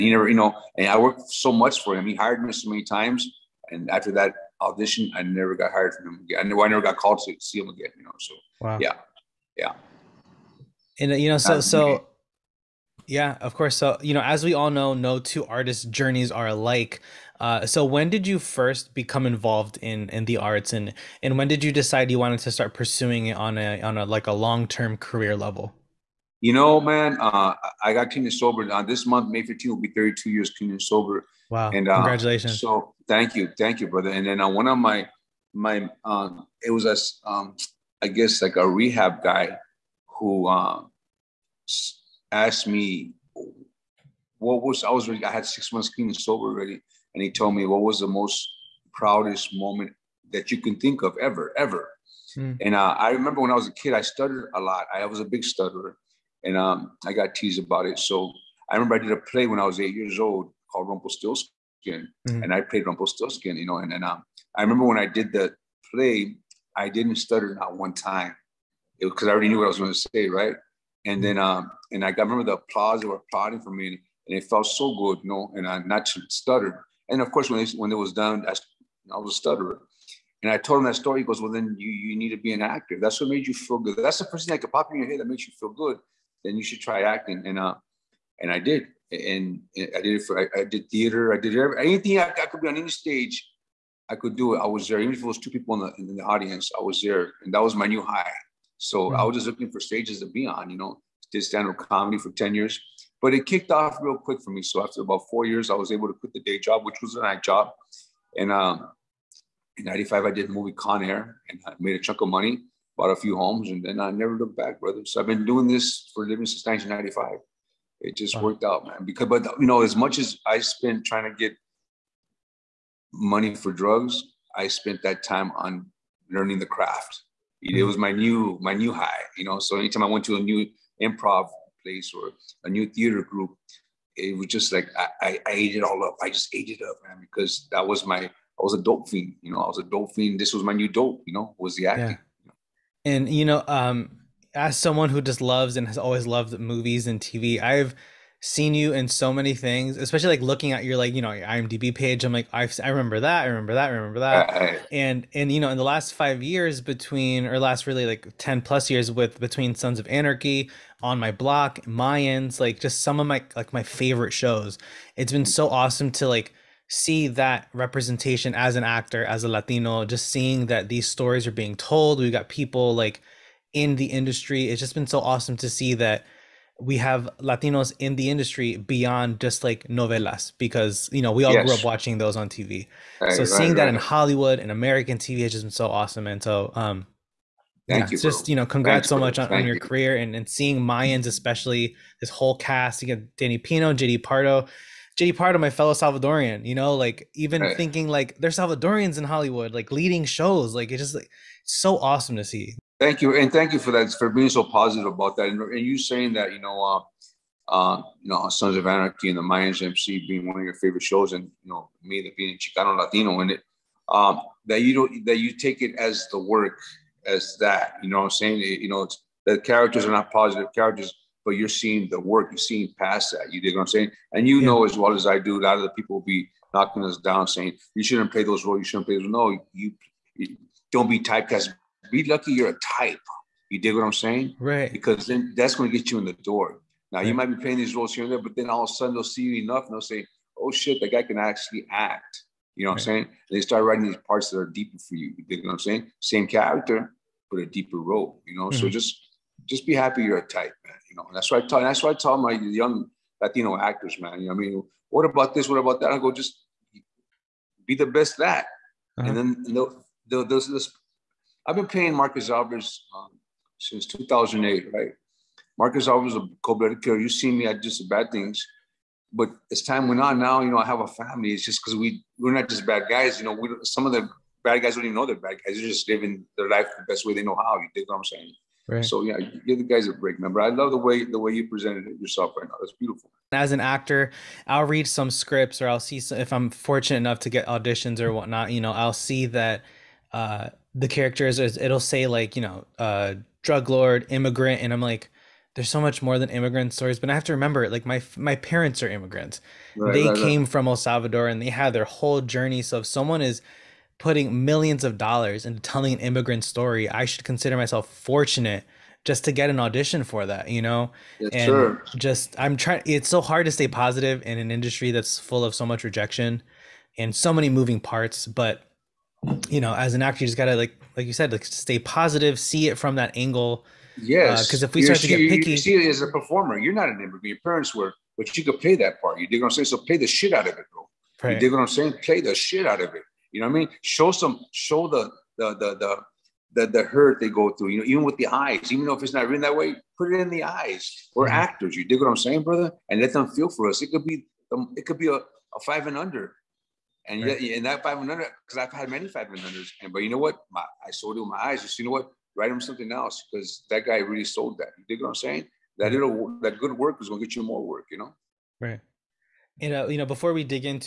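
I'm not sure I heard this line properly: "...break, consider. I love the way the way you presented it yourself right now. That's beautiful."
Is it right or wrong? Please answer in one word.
wrong.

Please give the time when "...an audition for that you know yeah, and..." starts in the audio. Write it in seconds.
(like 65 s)
309 s.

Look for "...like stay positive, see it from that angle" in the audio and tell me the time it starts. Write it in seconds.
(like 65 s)
321 s.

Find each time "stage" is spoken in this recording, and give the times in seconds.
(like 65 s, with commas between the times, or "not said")
92 s, 99 s.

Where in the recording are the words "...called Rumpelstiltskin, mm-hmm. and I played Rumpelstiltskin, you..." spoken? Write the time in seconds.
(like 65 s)
60 s.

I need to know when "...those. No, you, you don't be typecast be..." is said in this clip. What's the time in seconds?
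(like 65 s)
229 s.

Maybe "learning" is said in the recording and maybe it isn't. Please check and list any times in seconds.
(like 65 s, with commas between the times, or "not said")
126 s.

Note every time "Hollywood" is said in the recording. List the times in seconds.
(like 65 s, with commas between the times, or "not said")
183 s, 199 s.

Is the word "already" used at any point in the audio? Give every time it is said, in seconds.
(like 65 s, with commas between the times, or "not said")
46 s, 69 s.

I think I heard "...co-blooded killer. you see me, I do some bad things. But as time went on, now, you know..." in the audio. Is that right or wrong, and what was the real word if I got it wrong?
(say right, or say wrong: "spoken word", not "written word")
right.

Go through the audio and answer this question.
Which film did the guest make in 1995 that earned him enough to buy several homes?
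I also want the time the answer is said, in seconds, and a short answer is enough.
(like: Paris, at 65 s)
Con Air, at 110 s.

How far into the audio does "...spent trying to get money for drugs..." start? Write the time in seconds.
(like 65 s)
120 s.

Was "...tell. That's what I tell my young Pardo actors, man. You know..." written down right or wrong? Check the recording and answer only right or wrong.
wrong.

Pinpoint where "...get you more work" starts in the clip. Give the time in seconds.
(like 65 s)
357 s.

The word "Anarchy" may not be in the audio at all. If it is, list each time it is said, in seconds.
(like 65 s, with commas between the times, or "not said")
160 s, 208 s.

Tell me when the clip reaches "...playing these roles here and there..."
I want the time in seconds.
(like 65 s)
237 s.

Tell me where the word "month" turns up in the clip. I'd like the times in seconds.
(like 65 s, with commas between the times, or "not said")
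29 s, 45 s.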